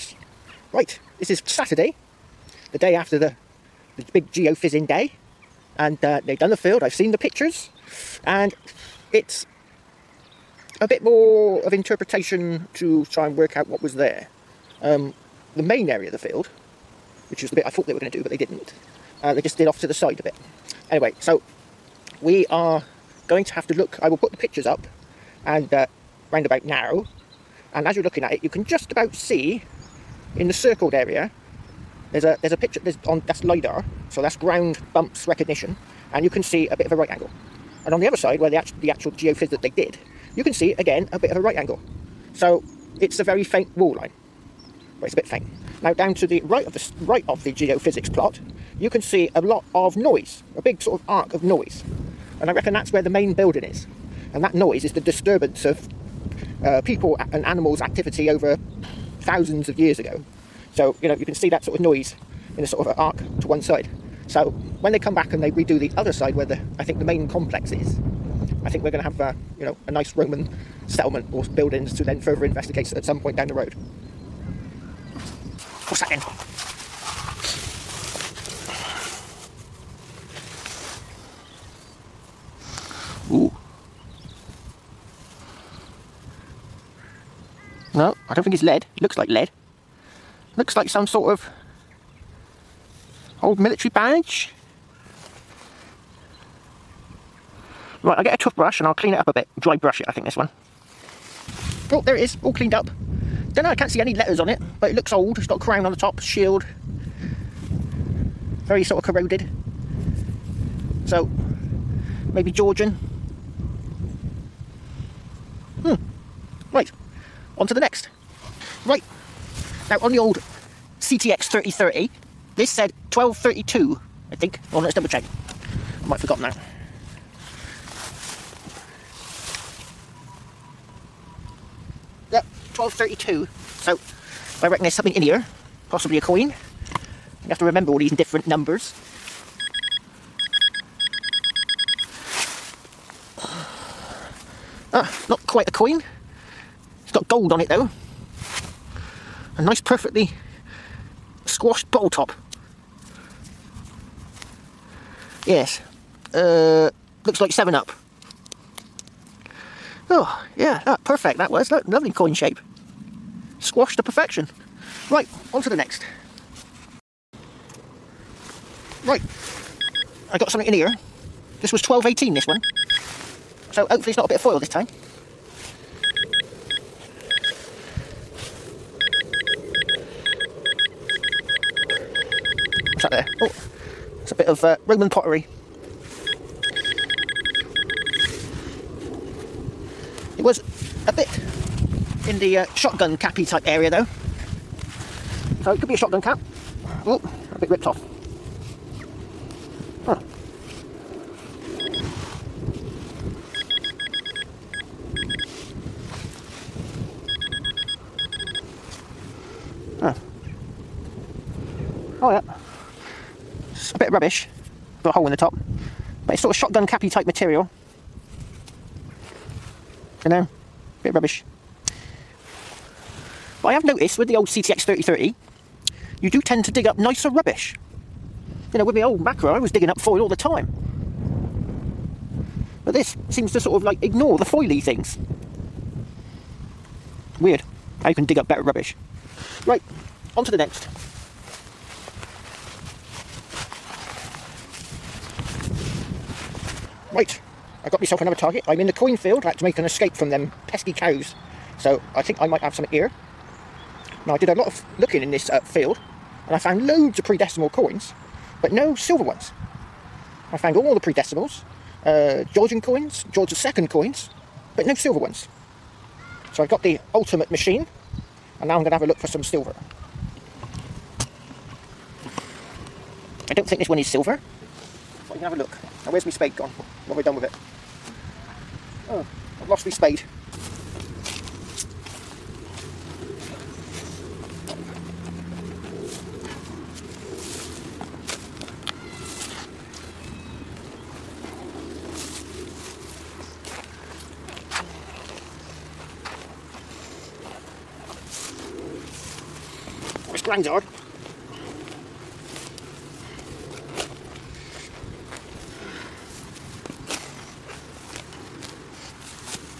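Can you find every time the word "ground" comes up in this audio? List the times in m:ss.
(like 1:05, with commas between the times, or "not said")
0:34.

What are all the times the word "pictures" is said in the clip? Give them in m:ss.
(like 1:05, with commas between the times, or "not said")
0:07, 0:24, 0:32.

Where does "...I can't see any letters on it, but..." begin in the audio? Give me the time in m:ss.
1:43.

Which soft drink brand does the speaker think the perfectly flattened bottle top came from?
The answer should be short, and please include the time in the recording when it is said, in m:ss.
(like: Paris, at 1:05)
7-Up, at 2:37.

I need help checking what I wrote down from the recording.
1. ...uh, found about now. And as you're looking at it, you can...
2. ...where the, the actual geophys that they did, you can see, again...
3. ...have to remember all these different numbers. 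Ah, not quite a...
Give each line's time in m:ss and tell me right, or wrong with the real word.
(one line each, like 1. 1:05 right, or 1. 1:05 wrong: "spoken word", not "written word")
1. 0:25 wrong: "round", not "found"
2. 0:38 right
3. 2:17 right.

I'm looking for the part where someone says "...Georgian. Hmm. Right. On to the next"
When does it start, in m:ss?
1:52.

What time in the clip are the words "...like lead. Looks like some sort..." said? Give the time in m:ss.
1:29.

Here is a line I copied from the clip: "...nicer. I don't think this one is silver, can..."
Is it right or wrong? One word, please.
wrong.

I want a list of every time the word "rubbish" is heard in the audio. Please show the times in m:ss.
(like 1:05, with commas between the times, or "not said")
3:34, 3:41, 3:47, 3:58.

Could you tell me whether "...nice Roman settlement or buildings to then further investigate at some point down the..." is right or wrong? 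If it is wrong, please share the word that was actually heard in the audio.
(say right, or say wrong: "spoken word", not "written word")
right.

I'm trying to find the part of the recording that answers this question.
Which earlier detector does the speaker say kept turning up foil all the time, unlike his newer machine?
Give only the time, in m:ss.
3:49.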